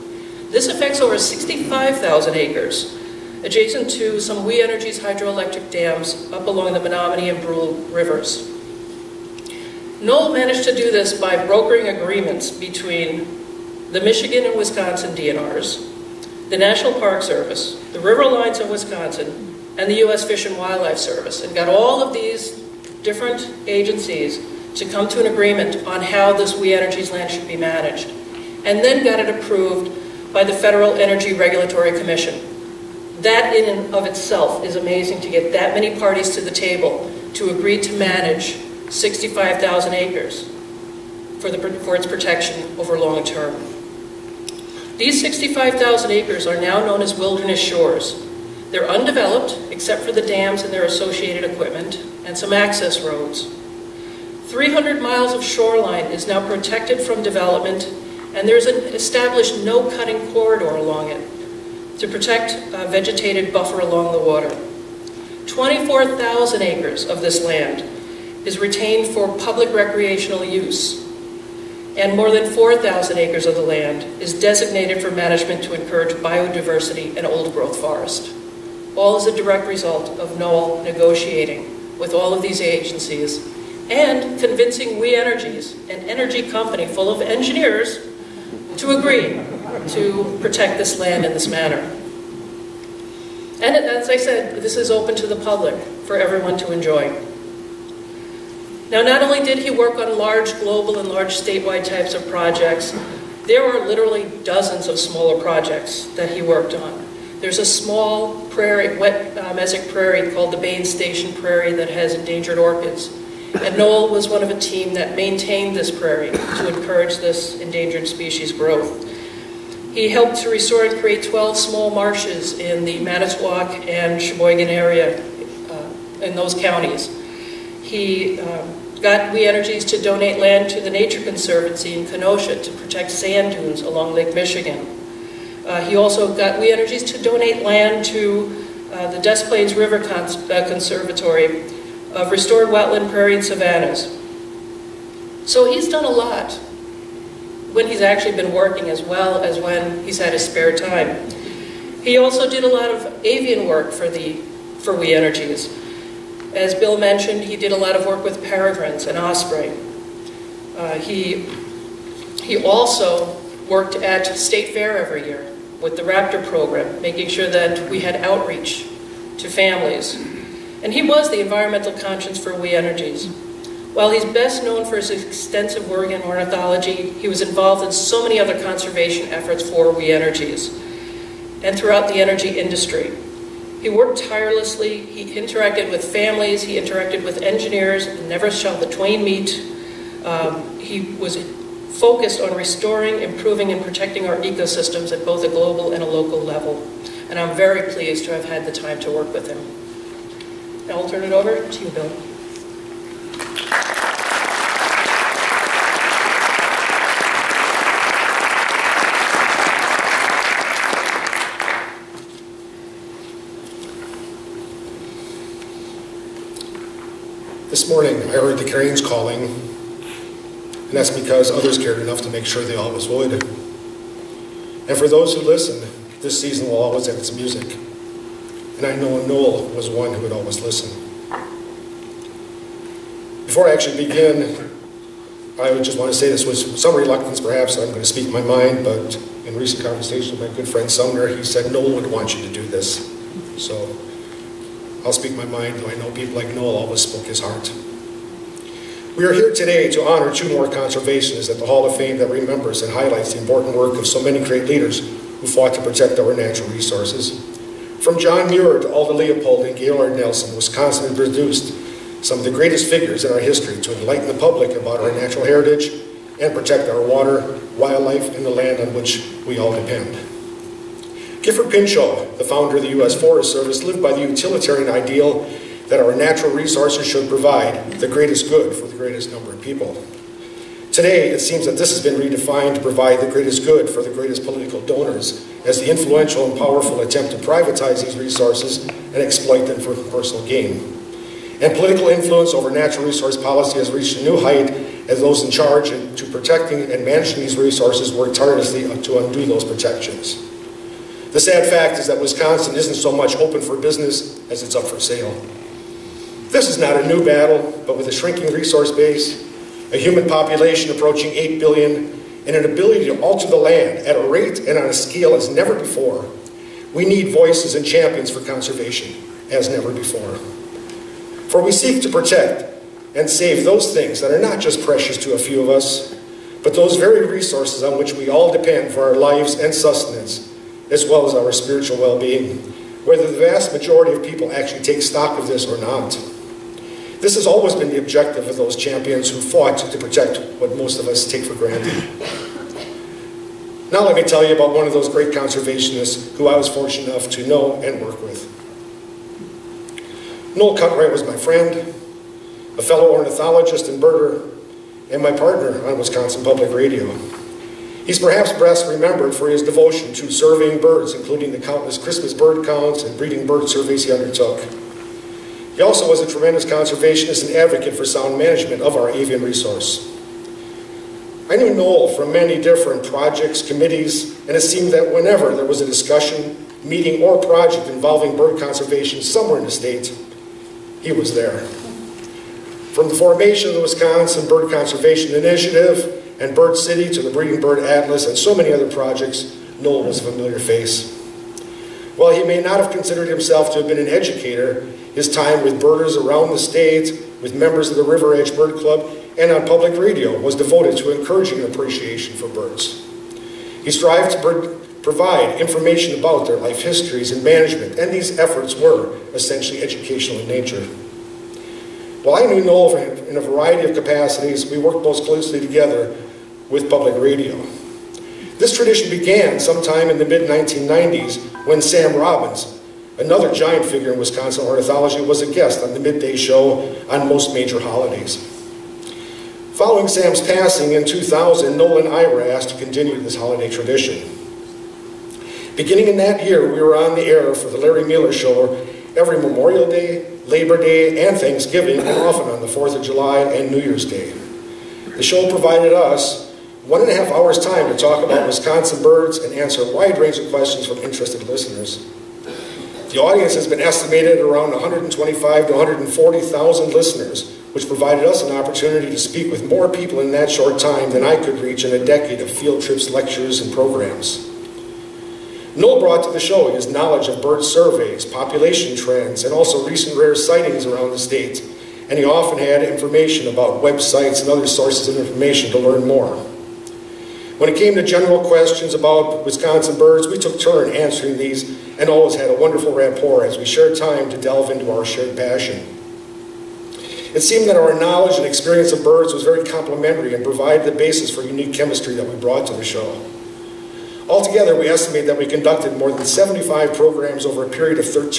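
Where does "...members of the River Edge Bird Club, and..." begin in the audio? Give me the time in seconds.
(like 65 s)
397 s.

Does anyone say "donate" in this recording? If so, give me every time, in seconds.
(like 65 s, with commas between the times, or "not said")
130 s, 137 s.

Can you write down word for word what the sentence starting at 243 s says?
So I'll speak my mind, though I know people like Noel always spoke his heart.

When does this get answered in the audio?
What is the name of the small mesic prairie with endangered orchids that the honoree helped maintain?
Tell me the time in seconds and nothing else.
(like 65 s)
110 s.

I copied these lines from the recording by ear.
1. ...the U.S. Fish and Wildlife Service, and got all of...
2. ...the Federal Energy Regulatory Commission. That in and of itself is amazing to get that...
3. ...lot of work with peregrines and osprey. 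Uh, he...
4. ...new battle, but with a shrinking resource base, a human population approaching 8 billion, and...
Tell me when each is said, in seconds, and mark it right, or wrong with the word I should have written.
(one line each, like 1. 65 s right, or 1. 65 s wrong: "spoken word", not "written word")
1. 19 s right
2. 30 s right
3. 157 s right
4. 307 s right.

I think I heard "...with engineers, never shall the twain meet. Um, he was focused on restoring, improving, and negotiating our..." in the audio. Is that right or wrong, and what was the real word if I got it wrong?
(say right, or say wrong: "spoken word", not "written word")
wrong: "protecting", not "negotiating".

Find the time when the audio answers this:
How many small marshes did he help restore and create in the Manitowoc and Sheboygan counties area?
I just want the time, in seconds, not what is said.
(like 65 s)
121 s.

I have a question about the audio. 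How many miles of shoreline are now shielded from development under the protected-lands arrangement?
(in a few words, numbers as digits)
300.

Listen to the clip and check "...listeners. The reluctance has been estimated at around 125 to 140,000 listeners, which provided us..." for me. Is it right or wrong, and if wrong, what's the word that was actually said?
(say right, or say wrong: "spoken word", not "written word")
wrong: "audience", not "reluctance".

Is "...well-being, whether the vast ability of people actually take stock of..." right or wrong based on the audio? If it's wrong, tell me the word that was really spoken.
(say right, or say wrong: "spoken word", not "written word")
wrong: "majority", not "ability".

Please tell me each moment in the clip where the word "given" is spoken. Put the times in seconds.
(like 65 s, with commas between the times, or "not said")
not said.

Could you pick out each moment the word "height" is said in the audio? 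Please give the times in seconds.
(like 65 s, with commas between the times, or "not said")
294 s.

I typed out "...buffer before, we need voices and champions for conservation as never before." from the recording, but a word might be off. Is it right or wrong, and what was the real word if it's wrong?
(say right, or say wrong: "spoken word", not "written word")
wrong: "never", not "buffer".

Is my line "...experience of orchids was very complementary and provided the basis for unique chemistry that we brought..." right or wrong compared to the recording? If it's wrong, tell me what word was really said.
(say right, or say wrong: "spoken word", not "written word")
wrong: "birds", not "orchids".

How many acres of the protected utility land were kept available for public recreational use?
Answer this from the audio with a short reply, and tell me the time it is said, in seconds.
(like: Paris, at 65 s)
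24,000, at 65 s.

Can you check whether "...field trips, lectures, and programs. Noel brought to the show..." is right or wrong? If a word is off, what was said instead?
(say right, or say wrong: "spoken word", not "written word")
right.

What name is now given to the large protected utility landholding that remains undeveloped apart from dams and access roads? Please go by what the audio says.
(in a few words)
Wilderness shores.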